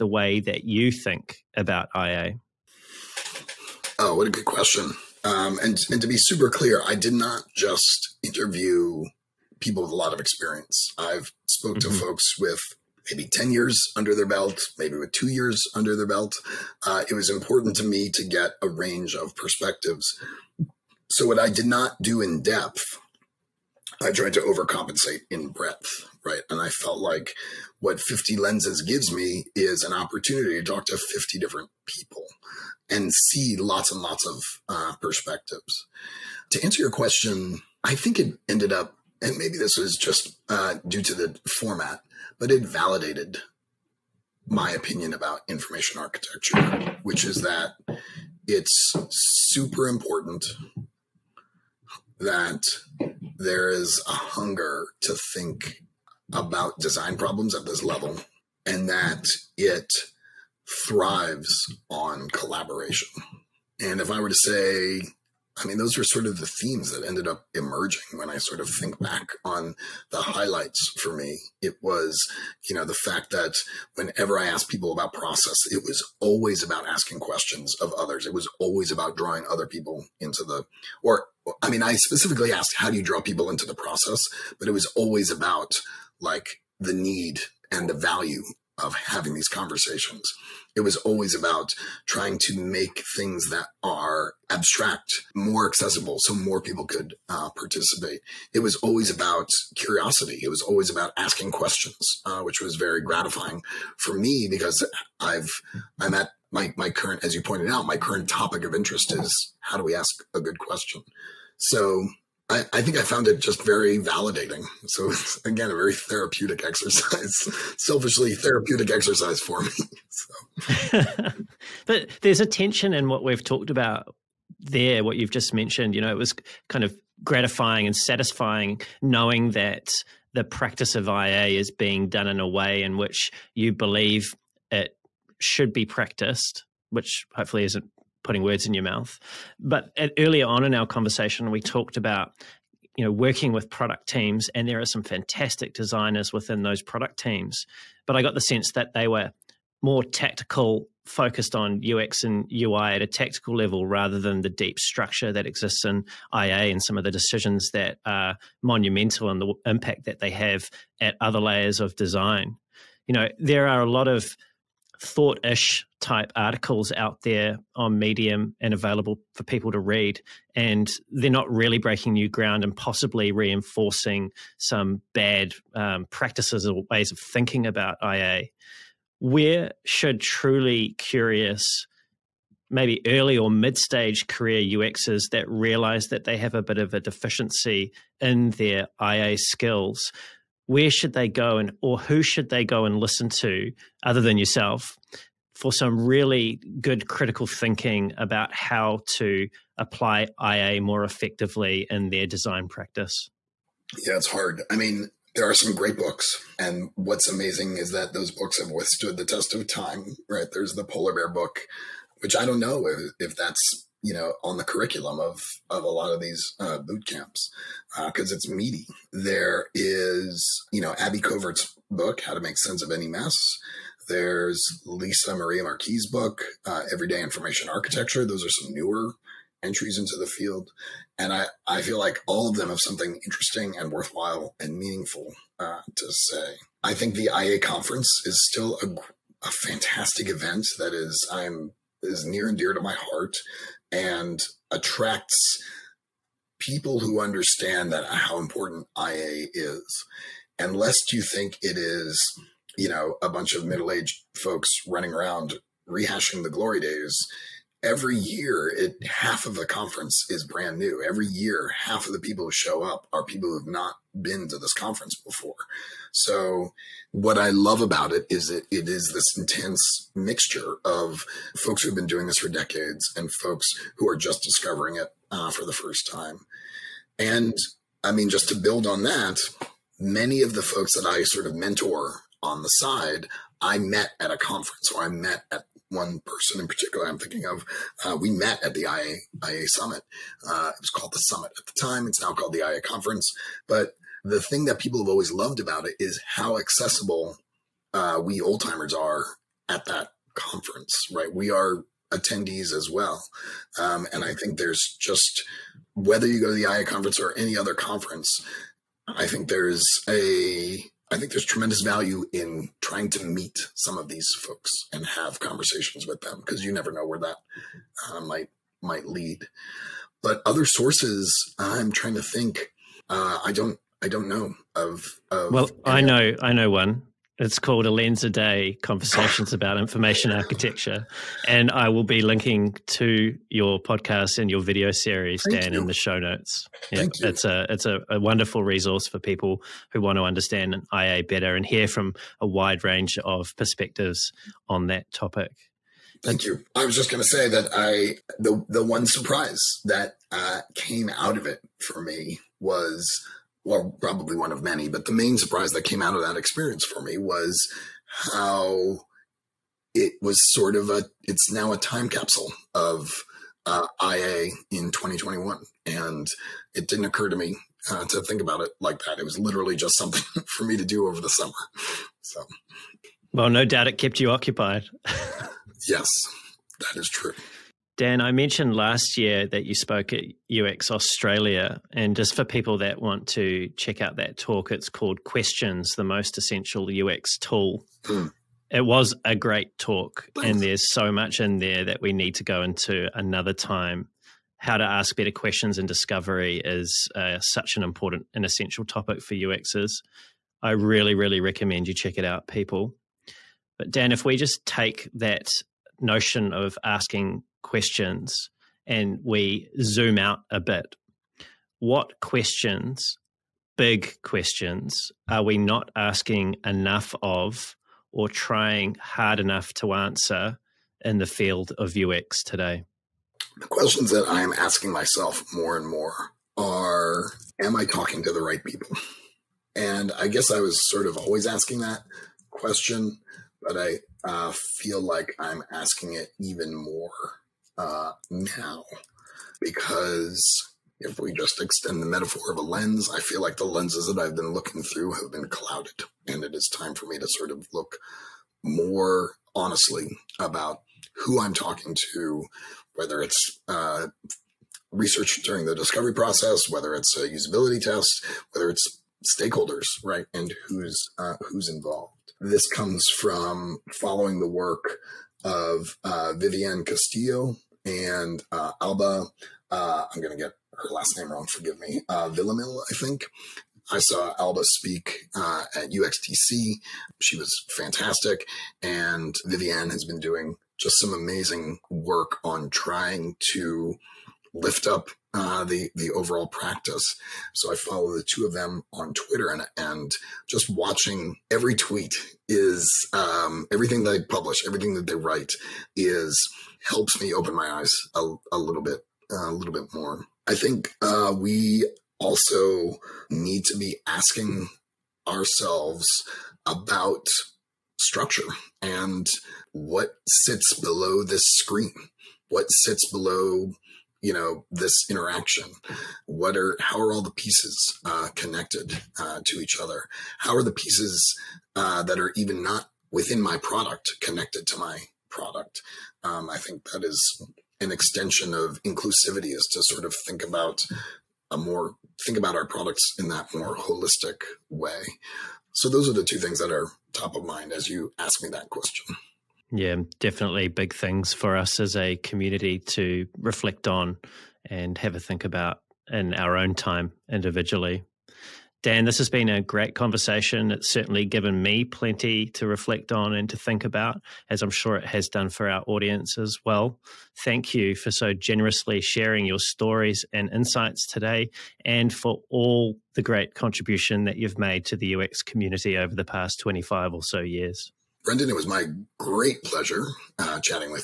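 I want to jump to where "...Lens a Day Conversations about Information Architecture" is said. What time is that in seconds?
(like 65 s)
327 s.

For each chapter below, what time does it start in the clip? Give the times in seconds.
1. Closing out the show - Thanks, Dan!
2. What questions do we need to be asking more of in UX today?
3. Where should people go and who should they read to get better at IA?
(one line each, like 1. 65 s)
1. 548 s
2. 377 s
3. 121 s.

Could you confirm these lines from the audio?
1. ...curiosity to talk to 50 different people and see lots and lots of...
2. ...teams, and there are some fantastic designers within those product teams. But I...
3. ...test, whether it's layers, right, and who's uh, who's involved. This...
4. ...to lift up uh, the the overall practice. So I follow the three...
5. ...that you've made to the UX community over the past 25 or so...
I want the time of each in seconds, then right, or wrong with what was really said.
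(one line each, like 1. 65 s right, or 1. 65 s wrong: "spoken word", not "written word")
1. 30 s wrong: "opportunity", not "curiosity"
2. 144 s right
3. 457 s wrong: "stakeholders", not "layers"
4. 483 s wrong: "two", not "three"
5. 564 s right.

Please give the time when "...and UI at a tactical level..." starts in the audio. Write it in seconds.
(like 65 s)
152 s.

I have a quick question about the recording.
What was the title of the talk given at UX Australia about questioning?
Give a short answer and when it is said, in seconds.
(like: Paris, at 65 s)
Questions, the Most Essential UX Tool, at 385 s.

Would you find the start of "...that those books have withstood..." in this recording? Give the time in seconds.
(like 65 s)
207 s.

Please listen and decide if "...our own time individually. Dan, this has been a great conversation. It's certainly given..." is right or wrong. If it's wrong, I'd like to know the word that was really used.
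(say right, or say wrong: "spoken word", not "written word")
right.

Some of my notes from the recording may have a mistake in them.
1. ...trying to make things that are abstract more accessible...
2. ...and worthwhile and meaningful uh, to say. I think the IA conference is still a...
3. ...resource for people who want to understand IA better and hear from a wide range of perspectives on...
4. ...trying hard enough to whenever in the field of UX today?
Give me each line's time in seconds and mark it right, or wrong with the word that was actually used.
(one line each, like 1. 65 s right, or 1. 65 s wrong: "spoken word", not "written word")
1. 92 s right
2. 233 s right
3. 338 s right
4. 418 s wrong: "answer", not "whenever".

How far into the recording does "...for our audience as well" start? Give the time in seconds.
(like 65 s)
555 s.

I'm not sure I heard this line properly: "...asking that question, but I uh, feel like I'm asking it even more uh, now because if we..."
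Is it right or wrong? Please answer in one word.
right.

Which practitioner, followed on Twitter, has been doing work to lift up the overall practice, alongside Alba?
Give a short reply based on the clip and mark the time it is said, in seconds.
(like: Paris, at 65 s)
Vivianne Castillo, at 466 s.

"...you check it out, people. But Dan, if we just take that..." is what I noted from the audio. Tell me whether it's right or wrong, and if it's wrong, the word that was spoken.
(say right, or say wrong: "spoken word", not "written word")
right.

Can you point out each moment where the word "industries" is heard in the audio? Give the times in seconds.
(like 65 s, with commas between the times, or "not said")
not said.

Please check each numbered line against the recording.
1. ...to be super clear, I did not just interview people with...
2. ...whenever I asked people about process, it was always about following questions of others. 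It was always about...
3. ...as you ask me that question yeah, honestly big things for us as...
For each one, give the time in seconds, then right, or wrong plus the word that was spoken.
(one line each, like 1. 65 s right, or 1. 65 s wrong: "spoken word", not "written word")
1. 6 s right
2. 73 s wrong: "asking", not "following"
3. 537 s wrong: "definitely", not "honestly".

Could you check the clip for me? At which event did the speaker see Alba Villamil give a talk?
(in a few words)
UXTC.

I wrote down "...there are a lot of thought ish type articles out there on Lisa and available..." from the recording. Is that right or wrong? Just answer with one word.
wrong.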